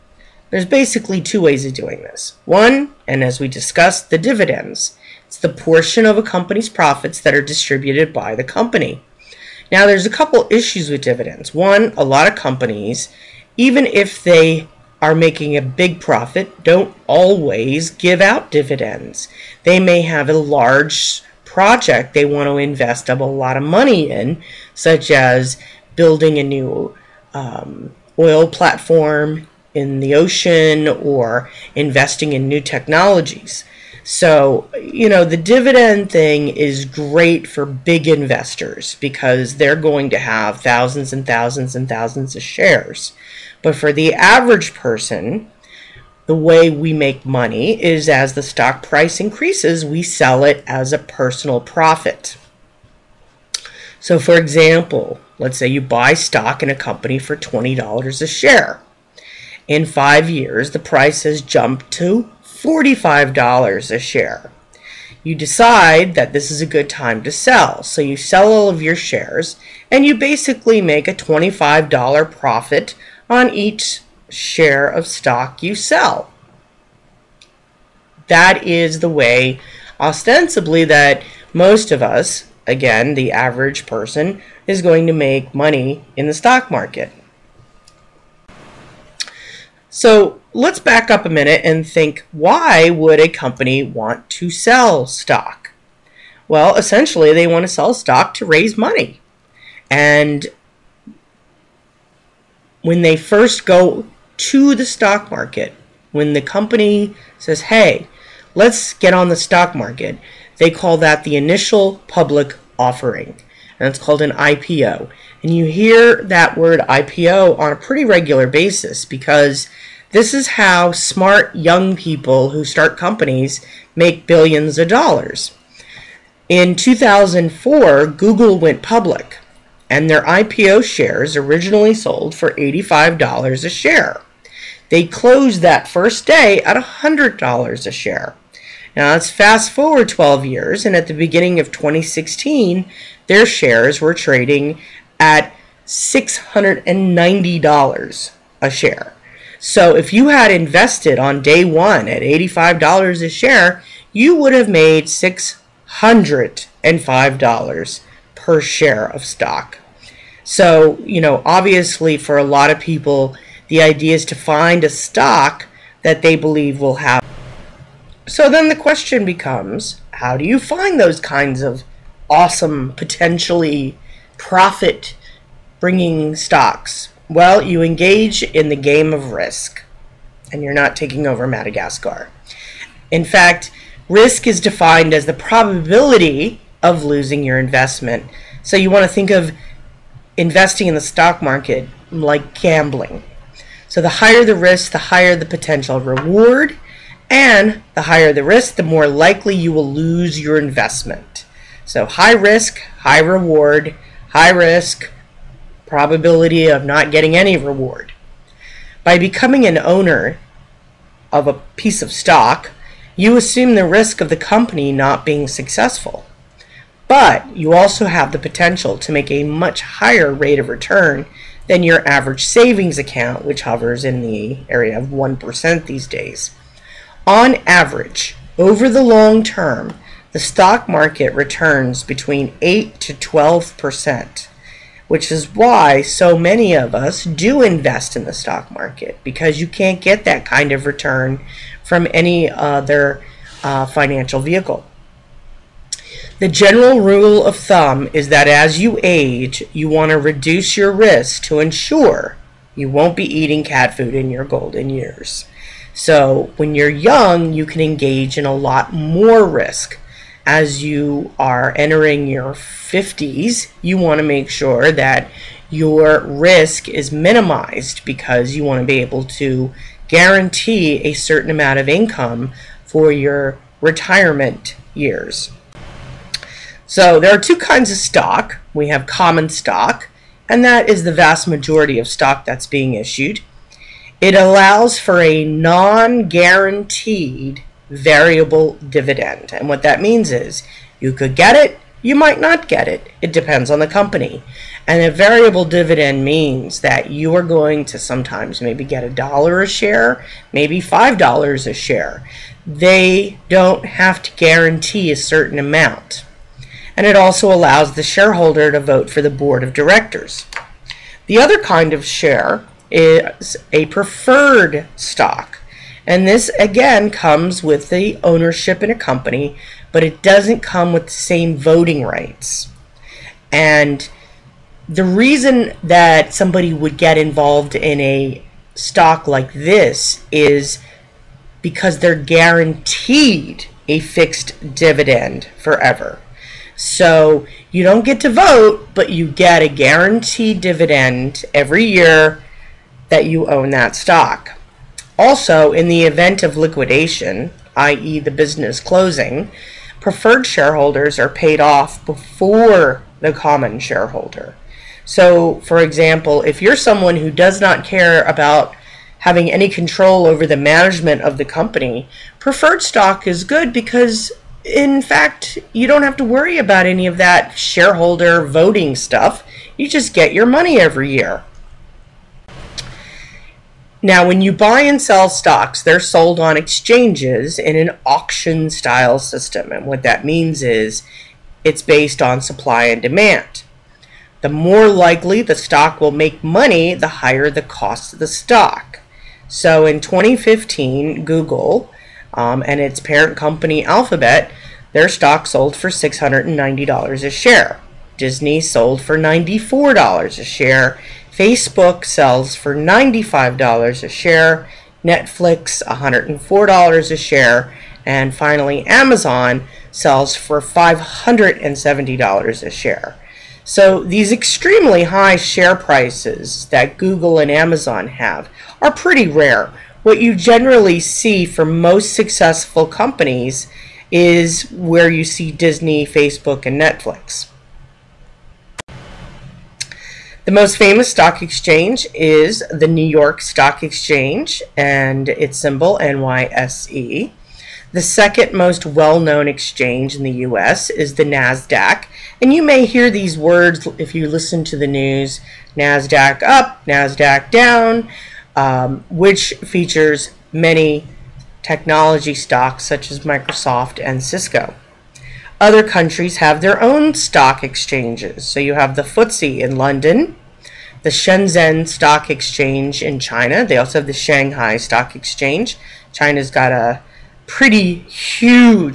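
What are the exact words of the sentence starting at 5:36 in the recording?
So you don't get to vote, but you get a guaranteed dividend every year that you own that stock.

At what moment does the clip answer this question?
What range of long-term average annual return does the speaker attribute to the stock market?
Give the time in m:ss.
3:52.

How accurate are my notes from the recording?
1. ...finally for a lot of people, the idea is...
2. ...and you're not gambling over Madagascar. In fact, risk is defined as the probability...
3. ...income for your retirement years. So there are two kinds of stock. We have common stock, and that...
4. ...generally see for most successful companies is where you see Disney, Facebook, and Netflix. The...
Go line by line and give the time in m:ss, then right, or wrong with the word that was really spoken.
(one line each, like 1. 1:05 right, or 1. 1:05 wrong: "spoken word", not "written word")
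1. 2:41 wrong: "obviously", not "finally"
2. 3:00 wrong: "taking", not "gambling"
3. 4:31 right
4. 7:00 right.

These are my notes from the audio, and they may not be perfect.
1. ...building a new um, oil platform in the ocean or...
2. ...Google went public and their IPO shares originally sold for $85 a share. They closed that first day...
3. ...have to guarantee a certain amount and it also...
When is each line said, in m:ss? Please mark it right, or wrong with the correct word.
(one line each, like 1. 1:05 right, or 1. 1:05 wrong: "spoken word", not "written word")
1. 0:25 right
2. 2:08 right
3. 5:03 right.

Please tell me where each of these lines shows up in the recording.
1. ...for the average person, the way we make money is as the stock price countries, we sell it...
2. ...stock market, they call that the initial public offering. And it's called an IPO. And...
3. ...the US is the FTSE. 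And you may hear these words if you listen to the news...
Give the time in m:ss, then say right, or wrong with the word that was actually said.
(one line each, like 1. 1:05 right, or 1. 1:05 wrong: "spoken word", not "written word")
1. 0:43 wrong: "increases", not "countries"
2. 1:49 right
3. 7:20 wrong: "NASDAQ", not "FTSE".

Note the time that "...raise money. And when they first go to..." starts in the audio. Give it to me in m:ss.
1:38.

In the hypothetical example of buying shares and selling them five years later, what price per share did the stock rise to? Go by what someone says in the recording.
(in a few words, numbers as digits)
$45.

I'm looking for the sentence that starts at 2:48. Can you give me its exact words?
So then the question becomes, how do you find those kinds of awesome, potentially profit bringing stocks?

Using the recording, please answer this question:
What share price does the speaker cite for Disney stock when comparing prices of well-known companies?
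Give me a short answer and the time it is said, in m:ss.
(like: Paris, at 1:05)
$94, at 6:39.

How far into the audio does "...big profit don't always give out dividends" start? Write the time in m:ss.
0:15.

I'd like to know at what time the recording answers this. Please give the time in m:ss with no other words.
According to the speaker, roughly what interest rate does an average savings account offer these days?
3:45.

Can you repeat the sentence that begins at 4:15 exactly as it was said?
So, when you're young, you can engage in a lot more risk.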